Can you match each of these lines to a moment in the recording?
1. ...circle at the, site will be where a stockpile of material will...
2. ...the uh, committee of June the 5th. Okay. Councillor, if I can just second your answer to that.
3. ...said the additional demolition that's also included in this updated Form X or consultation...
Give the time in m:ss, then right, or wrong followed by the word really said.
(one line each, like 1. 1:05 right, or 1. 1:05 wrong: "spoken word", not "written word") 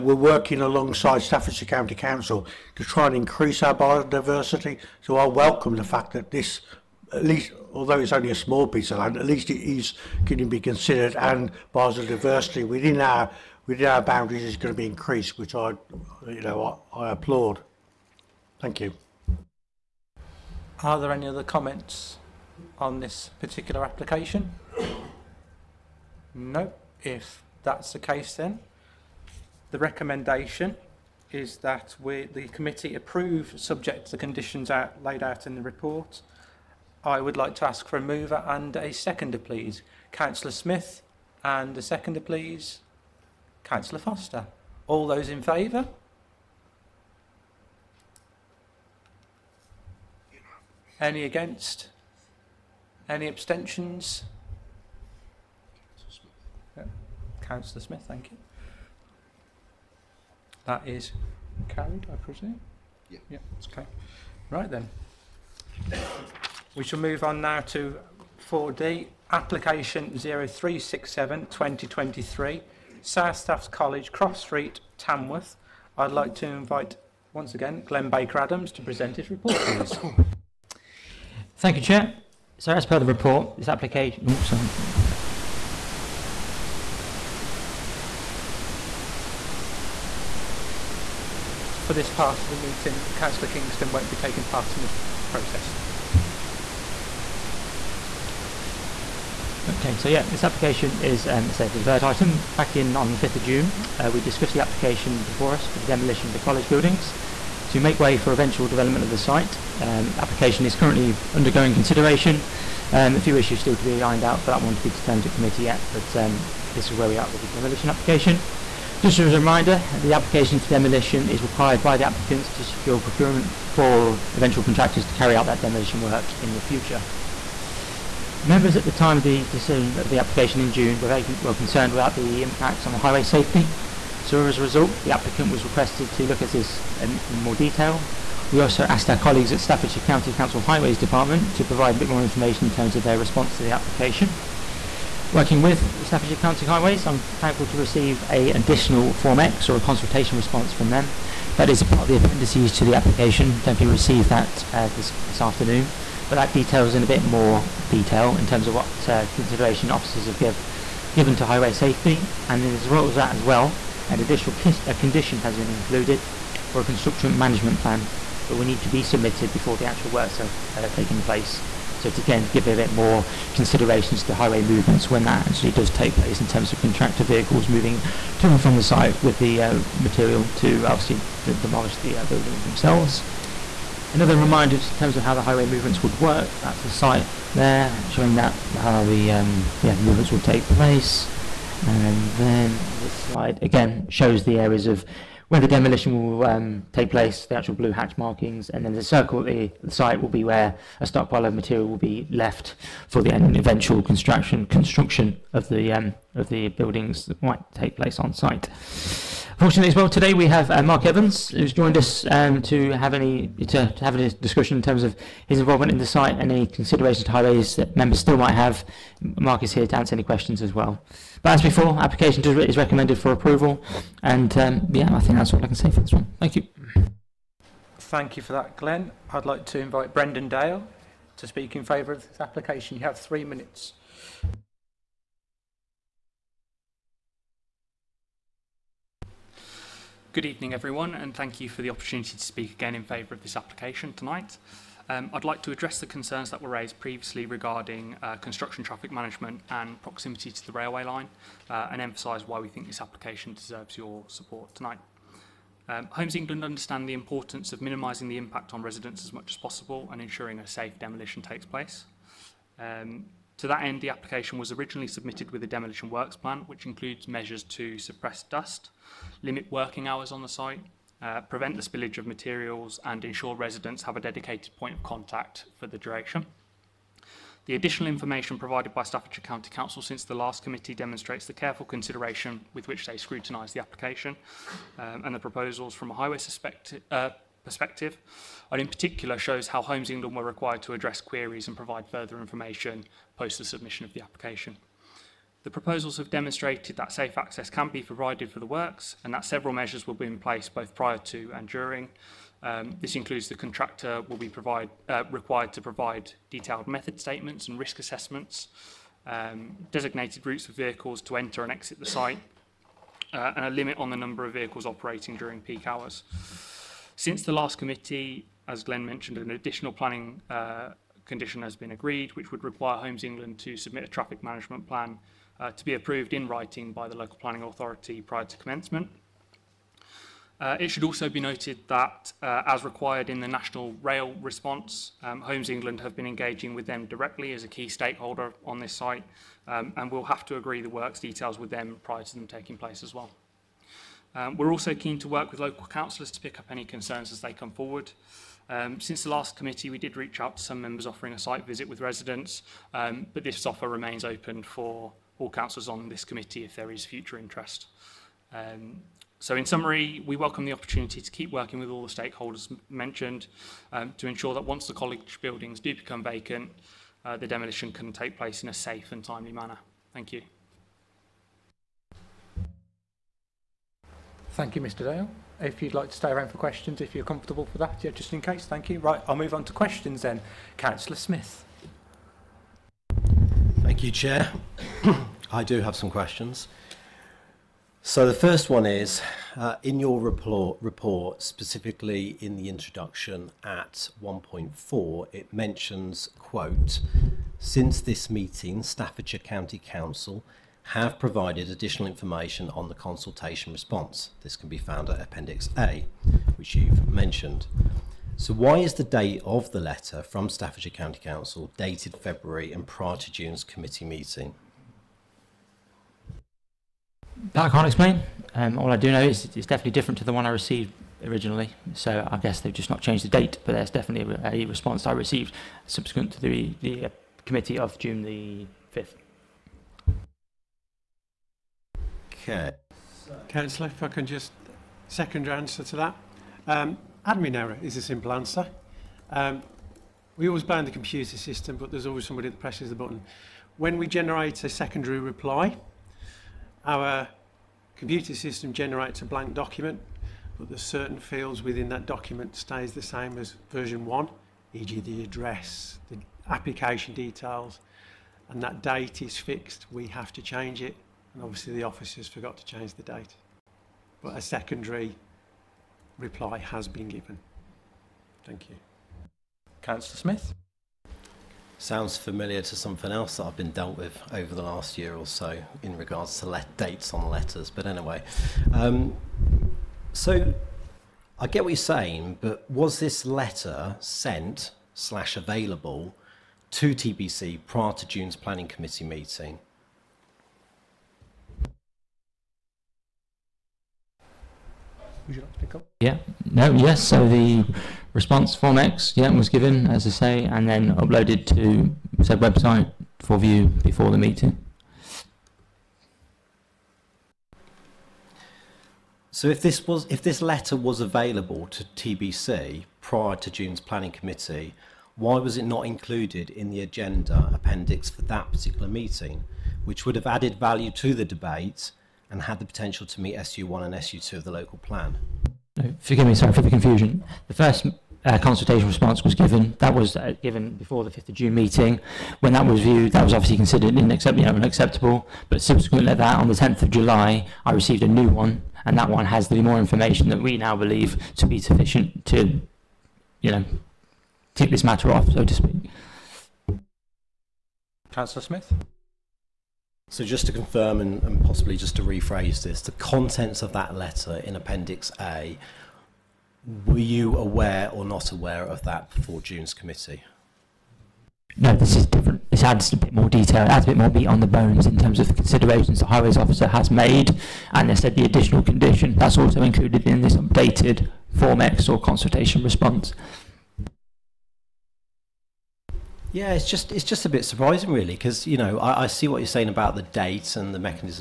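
1. 3:19 right
2. 7:06 right
3. 9:27 wrong: "condition", not "demolition".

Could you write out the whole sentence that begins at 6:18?
Right, I'll move on to questions then.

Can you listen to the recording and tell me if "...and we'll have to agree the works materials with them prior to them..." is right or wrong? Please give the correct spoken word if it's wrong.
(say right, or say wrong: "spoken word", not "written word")
wrong: "details", not "materials".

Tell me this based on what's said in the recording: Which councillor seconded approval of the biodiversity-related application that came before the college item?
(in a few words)
Councillor Foster.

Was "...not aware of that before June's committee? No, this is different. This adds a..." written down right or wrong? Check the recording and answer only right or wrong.
right.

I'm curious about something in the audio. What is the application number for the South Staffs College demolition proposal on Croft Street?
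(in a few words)
0367 2023.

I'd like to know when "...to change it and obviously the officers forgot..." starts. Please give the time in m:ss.
7:40.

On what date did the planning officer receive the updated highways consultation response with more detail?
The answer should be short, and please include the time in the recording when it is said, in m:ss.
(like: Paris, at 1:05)
10th of July, at 8:56.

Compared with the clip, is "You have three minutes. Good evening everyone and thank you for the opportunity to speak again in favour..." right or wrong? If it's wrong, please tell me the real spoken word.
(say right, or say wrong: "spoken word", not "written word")
right.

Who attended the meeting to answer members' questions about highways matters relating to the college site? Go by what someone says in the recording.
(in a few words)
Mark Evans.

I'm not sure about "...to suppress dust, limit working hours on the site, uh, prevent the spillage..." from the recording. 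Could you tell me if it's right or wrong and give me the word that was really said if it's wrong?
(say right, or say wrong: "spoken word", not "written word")
right.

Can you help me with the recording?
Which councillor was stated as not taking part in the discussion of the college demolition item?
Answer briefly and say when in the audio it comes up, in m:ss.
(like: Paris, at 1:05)
Councillor Kingston, at 1:33.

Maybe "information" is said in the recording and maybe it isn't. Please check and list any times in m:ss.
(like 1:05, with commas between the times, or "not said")
2:22, 4:38, 4:52, 6:42, 8:59.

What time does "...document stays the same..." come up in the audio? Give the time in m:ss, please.
7:32.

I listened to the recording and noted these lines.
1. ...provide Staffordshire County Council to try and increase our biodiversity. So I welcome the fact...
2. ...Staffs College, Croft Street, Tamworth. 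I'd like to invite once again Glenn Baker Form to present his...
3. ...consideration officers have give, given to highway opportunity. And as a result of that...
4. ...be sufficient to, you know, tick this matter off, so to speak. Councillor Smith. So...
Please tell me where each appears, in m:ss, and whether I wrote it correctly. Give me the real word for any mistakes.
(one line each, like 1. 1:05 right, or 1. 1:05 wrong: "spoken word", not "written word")
1. 0:00 wrong: "alongside", not "provide"
2. 1:13 wrong: "Adams", not "Form"
3. 2:39 wrong: "safety", not "opportunity"
4. 9:01 right.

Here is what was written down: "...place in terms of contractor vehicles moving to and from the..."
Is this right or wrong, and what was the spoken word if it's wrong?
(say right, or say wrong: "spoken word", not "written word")
right.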